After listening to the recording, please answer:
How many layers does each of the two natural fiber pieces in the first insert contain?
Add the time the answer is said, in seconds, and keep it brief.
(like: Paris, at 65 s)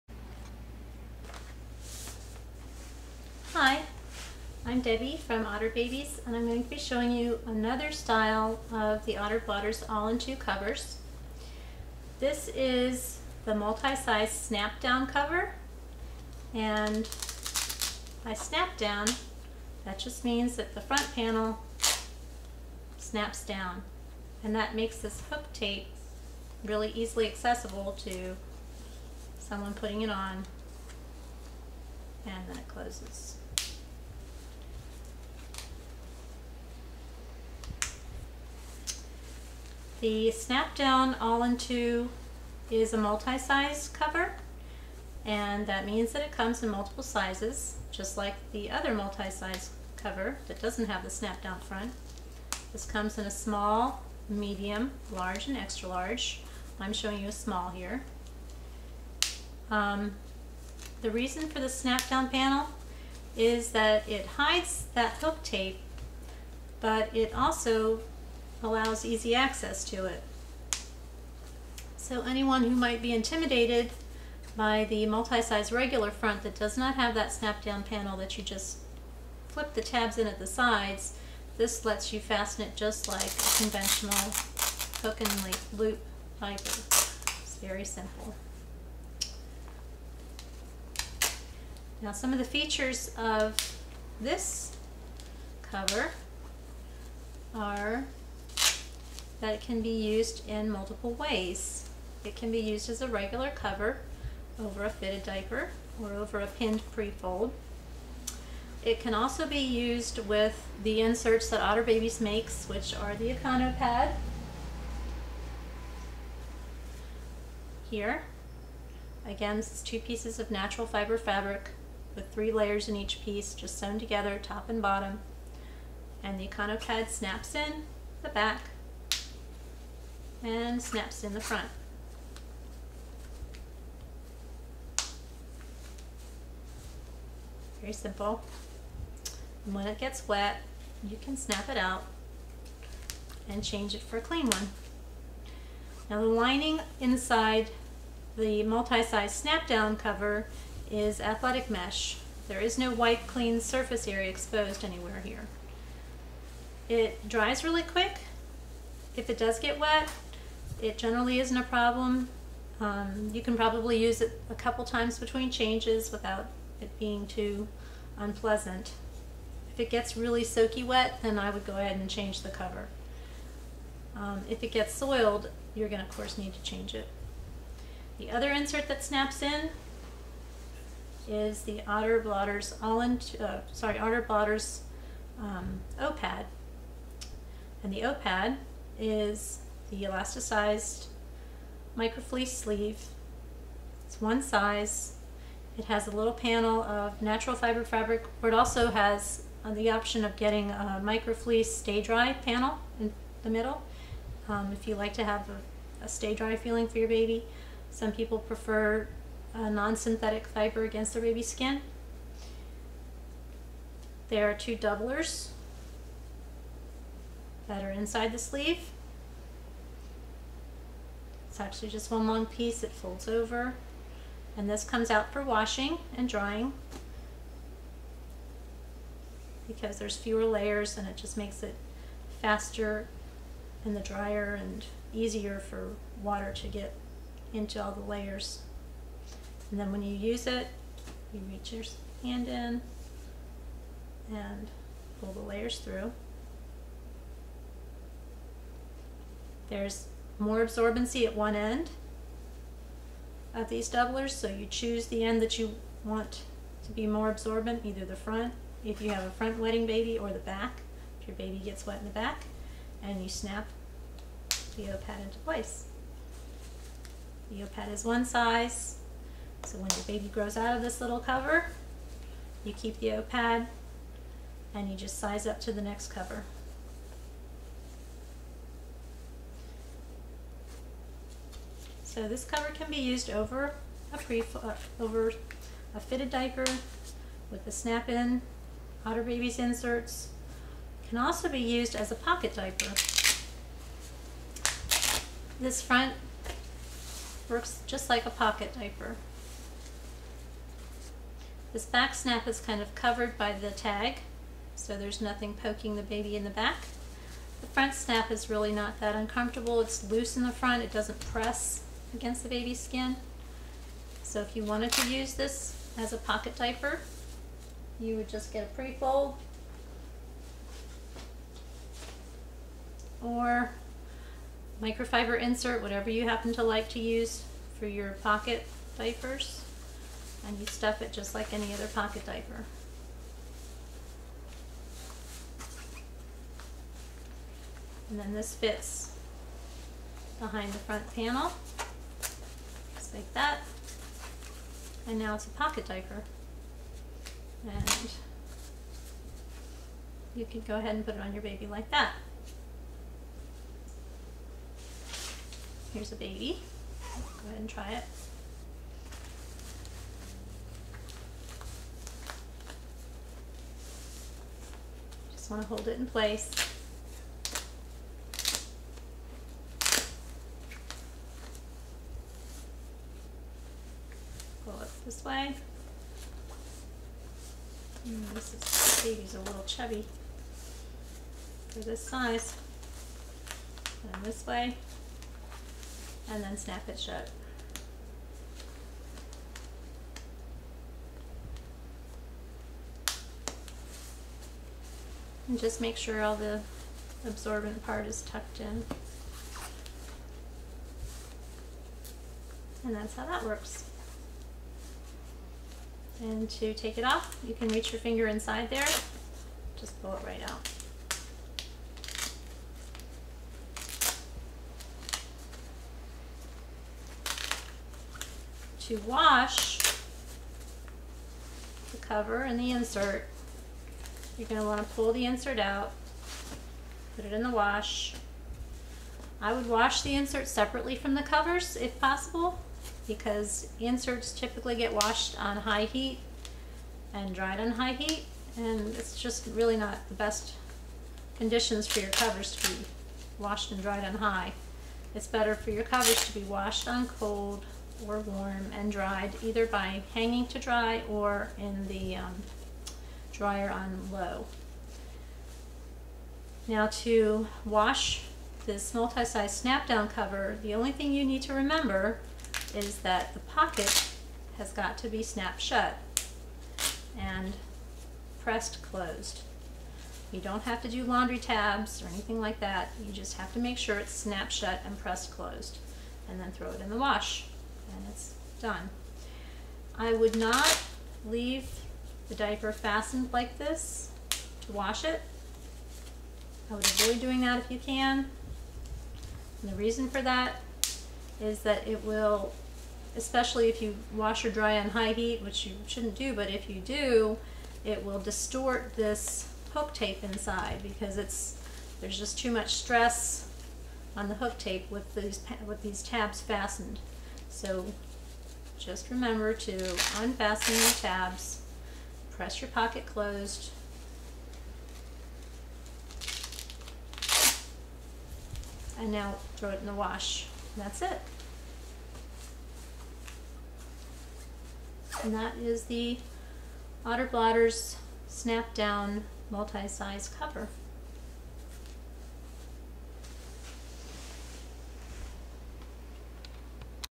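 3, at 122 s.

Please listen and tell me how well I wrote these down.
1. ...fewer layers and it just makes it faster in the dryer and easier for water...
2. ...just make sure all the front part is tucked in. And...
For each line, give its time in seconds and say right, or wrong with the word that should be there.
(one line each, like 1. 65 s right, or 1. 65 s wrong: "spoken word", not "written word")
1. 230 s right
2. 395 s wrong: "absorbent", not "front".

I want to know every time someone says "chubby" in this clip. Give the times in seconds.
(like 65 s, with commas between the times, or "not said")
379 s.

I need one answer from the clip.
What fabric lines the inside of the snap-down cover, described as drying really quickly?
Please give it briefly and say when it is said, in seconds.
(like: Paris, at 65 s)
athletic mesh, at 151 s.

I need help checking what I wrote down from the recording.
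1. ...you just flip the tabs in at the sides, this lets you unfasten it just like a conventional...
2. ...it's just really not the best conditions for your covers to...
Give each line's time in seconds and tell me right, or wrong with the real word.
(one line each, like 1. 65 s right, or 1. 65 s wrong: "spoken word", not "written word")
1. 78 s wrong: "fasten", not "unfasten"
2. 438 s right.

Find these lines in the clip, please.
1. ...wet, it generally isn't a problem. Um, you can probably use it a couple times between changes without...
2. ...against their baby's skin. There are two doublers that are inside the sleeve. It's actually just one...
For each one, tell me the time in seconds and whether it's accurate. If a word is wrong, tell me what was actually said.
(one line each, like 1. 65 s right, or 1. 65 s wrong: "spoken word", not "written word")
1. 159 s right
2. 210 s right.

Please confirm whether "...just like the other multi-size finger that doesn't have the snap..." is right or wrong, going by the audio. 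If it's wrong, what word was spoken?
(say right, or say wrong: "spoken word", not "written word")
wrong: "cover", not "finger".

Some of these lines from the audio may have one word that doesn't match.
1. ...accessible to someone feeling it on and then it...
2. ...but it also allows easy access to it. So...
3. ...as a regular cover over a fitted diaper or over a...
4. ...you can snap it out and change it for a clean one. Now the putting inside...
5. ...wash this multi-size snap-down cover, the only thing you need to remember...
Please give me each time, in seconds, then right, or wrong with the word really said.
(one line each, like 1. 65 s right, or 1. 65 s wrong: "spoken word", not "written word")
1. 27 s wrong: "putting", not "feeling"
2. 66 s right
3. 102 s right
4. 141 s wrong: "lining", not "putting"
5. 457 s right.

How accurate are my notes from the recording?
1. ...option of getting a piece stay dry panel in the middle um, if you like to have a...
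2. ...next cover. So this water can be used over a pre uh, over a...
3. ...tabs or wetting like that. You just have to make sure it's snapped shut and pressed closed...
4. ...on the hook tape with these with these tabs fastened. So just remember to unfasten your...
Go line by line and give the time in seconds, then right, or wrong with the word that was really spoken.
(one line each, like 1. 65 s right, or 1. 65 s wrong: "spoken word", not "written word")
1. 199 s wrong: "microfleece", not "piece"
2. 275 s wrong: "cover", not "water"
3. 471 s wrong: "anything", not "wetting"
4. 504 s right.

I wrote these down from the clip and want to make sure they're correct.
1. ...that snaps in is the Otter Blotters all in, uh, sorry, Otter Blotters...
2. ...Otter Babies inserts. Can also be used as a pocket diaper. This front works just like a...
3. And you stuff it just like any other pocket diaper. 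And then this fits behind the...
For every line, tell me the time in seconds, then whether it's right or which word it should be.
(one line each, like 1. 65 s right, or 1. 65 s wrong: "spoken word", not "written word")
1. 178 s right
2. 289 s right
3. 330 s right.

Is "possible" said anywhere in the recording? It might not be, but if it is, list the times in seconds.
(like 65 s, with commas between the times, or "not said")
431 s.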